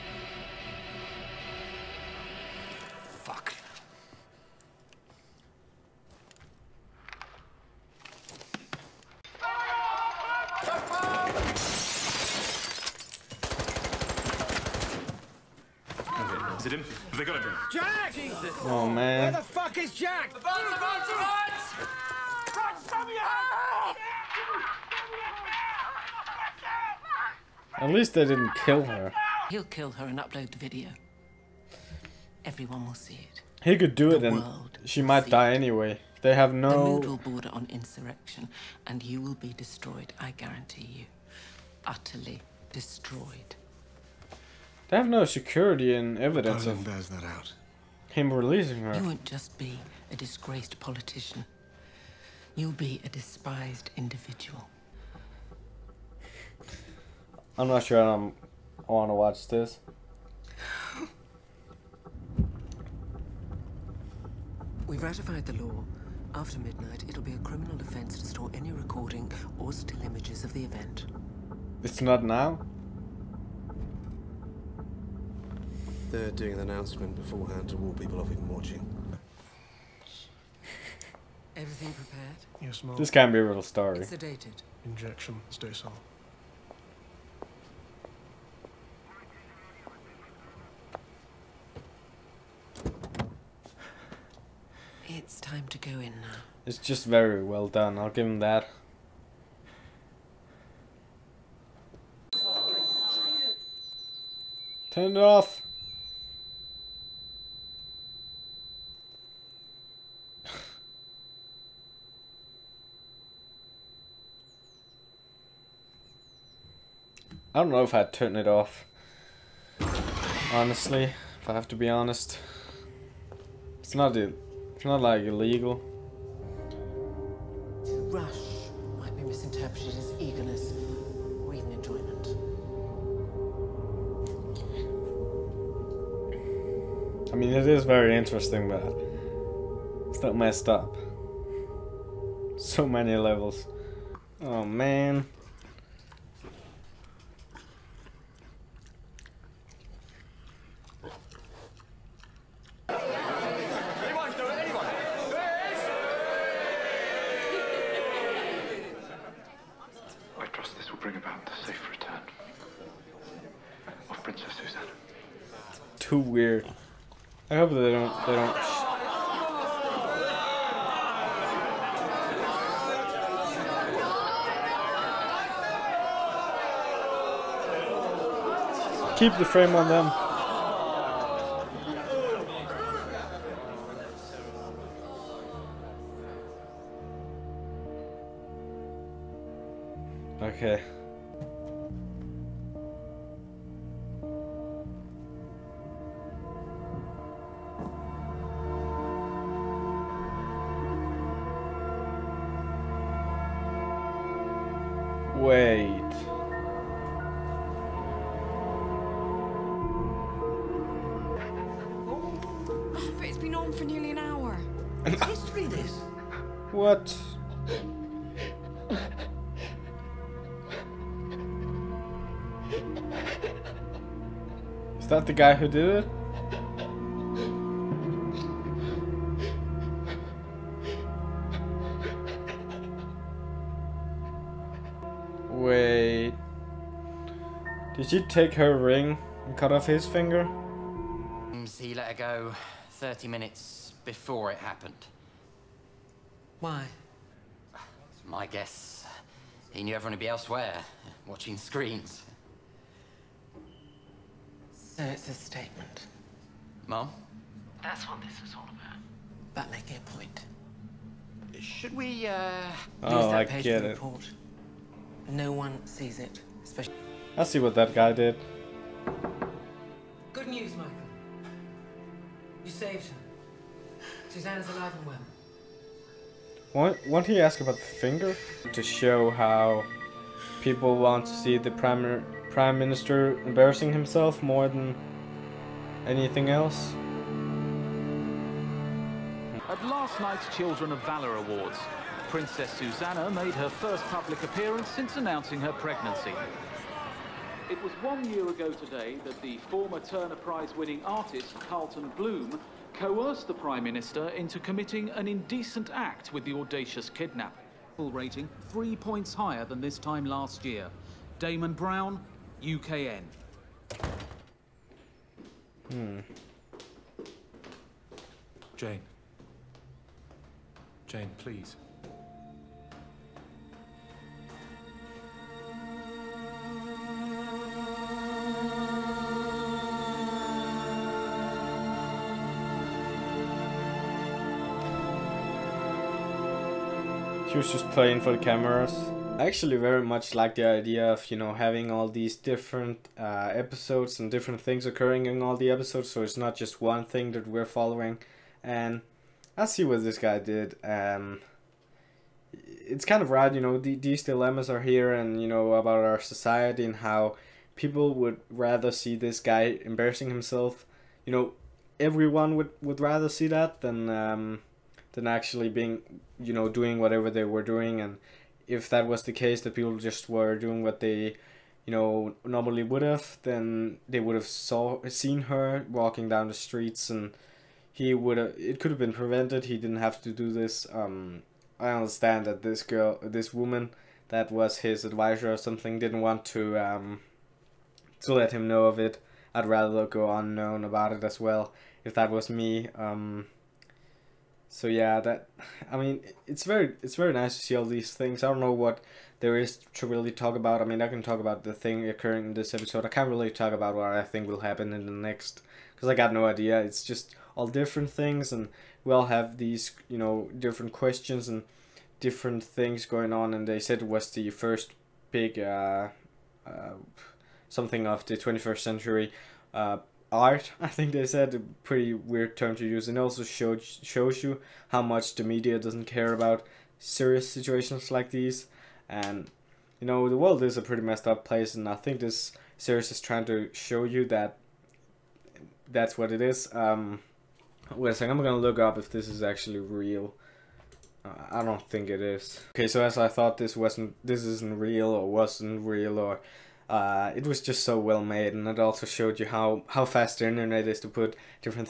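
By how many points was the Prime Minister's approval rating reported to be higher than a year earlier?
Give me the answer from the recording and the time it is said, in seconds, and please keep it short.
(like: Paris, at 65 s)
3, at 308 s.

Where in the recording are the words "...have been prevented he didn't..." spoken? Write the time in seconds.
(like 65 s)
378 s.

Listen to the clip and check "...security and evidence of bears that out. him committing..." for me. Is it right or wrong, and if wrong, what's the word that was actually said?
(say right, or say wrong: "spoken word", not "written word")
wrong: "releasing", not "committing".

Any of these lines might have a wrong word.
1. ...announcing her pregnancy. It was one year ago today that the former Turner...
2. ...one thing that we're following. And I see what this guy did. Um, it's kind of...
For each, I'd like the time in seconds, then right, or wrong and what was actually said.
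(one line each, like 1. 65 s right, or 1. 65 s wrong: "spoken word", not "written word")
1. 295 s right
2. 346 s right.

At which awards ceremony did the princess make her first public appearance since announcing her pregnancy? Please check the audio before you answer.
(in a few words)
Children of Valor Awards.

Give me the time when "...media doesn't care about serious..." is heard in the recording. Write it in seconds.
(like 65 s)
425 s.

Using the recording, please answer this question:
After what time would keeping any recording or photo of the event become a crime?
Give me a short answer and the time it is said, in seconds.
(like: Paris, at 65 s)
Midnight, at 66 s.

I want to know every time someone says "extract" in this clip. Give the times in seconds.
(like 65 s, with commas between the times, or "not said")
not said.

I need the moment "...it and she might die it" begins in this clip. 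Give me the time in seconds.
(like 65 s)
34 s.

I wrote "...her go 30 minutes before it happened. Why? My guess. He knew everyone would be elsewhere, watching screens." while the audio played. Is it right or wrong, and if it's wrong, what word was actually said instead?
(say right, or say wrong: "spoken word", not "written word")
right.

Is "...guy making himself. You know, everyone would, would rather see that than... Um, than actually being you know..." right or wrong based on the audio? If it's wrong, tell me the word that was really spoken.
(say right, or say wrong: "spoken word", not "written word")
wrong: "embarrassing", not "making".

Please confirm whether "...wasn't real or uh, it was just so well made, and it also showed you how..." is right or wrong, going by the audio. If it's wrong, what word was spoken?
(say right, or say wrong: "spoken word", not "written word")
right.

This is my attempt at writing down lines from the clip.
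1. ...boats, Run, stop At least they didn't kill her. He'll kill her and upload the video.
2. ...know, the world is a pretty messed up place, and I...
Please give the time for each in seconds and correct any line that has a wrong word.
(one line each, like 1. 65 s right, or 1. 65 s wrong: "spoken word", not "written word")
1. 20 s right
2. 430 s right.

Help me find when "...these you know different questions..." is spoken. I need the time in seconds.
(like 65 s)
409 s.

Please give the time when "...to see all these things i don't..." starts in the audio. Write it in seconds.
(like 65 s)
397 s.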